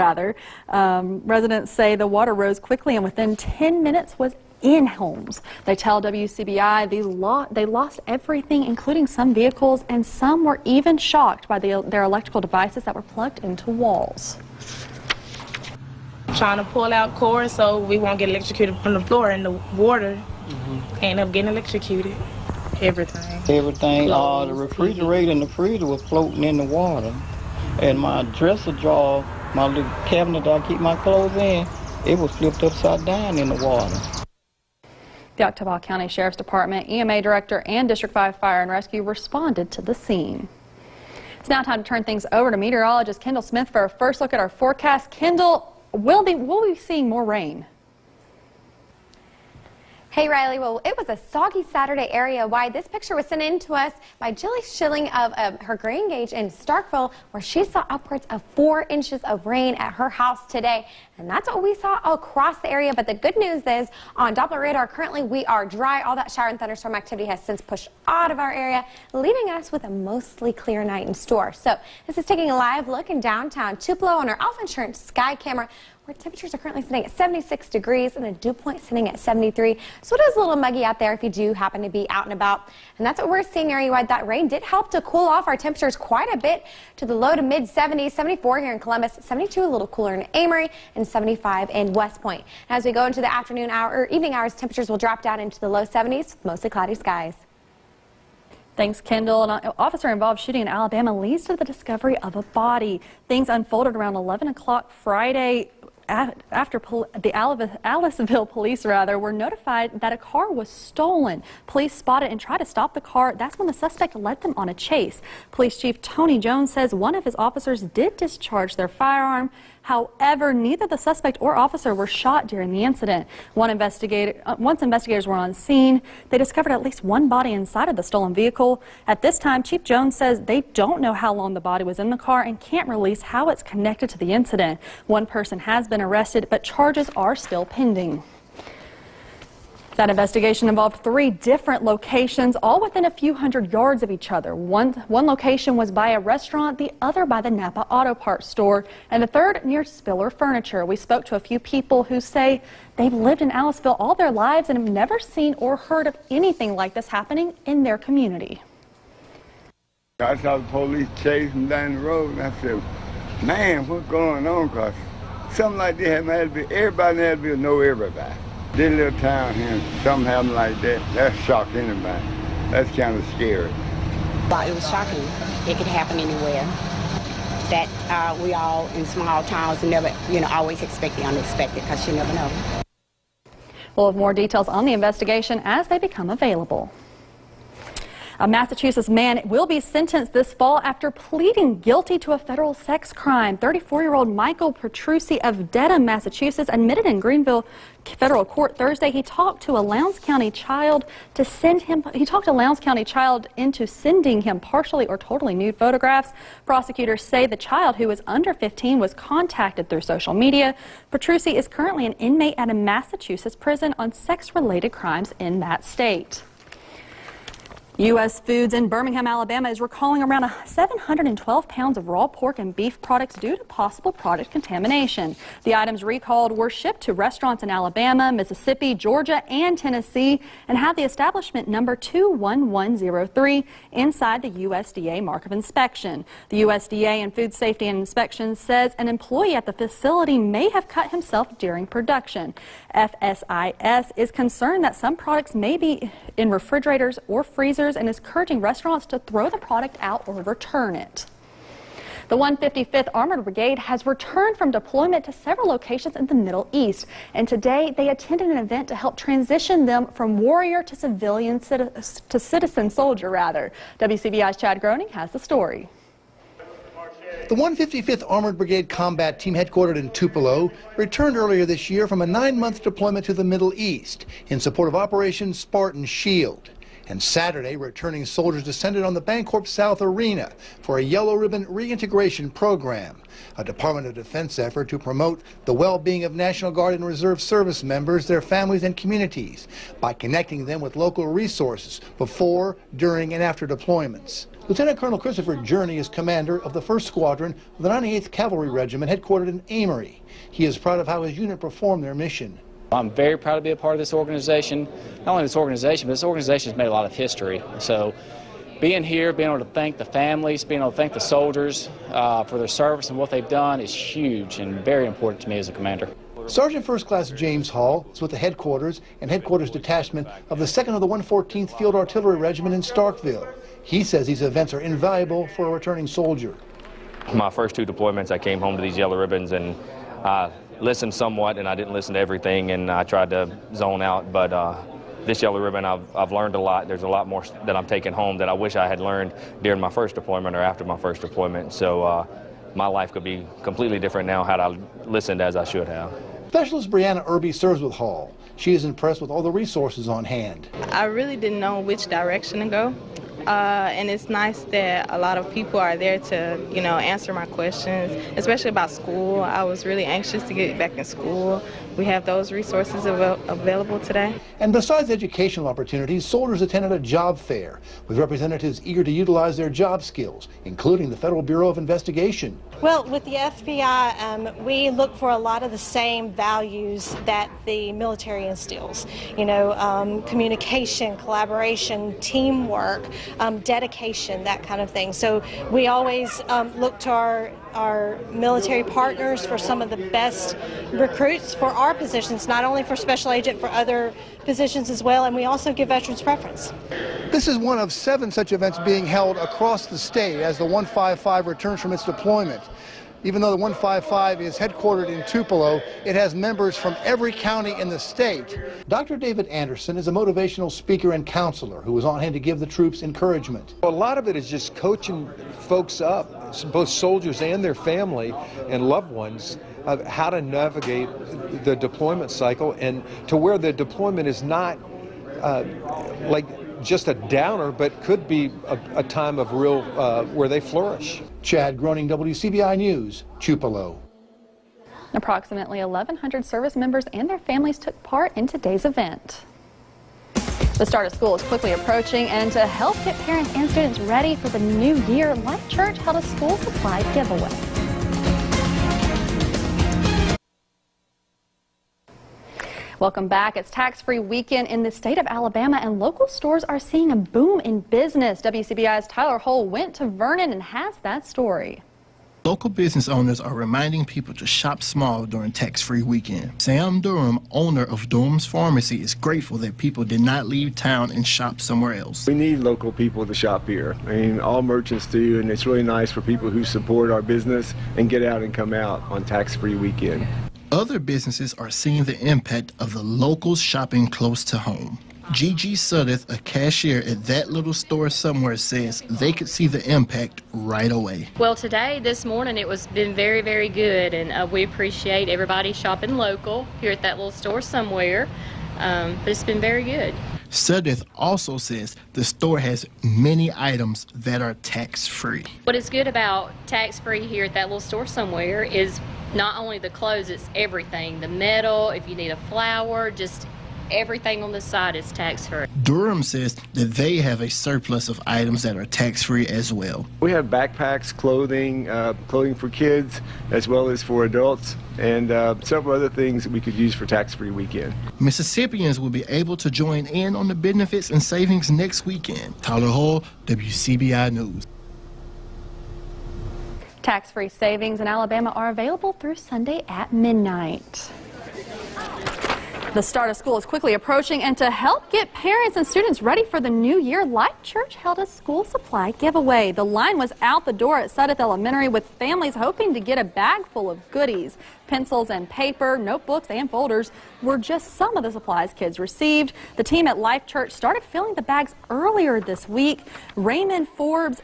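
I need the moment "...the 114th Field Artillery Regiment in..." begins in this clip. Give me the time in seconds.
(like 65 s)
321 s.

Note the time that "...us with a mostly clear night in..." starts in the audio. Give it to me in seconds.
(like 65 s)
69 s.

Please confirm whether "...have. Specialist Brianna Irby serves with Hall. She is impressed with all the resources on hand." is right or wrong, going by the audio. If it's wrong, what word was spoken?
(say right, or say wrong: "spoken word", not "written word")
right.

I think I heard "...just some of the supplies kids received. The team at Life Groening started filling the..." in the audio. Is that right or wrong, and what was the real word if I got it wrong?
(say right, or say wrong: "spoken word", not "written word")
wrong: "Church", not "Groening".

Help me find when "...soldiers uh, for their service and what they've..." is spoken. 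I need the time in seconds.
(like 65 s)
311 s.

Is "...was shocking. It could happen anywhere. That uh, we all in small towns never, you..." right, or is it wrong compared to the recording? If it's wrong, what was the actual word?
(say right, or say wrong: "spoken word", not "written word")
right.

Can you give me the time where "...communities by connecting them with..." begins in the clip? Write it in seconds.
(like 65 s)
288 s.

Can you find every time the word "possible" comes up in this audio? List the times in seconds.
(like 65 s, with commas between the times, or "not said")
223 s.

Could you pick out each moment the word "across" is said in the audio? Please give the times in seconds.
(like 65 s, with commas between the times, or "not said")
62 s, 399 s.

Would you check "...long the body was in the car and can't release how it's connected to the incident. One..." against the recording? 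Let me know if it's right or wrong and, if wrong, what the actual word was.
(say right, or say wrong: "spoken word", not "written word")
right.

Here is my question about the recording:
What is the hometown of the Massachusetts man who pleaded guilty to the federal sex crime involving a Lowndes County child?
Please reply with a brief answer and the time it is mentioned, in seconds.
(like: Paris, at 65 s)
Dedham, at 195 s.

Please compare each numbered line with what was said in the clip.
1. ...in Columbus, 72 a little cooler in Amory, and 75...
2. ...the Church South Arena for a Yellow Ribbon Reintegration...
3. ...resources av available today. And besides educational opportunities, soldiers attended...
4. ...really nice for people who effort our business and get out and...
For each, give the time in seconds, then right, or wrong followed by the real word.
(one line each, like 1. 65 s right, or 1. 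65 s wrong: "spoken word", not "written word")
1. 88 s right
2. 279 s wrong: "Bancorp", not "Church"
3. 362 s right
4. 475 s wrong: "support", not "effort".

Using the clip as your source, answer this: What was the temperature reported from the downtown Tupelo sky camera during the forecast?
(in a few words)
76 degrees.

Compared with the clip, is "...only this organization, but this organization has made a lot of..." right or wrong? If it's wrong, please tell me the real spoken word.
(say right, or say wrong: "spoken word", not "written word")
right.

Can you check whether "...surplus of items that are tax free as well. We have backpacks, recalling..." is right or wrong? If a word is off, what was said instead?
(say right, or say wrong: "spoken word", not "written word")
wrong: "clothing", not "recalling".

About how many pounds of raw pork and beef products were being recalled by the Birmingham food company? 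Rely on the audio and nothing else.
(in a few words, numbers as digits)
712 pounds.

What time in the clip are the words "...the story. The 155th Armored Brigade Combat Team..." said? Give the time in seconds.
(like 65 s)
265 s.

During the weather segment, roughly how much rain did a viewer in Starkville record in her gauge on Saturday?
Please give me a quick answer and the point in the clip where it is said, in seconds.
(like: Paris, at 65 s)
4 inches, at 58 s.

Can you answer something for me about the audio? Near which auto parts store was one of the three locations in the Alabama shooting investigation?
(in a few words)
Napa Auto Parts.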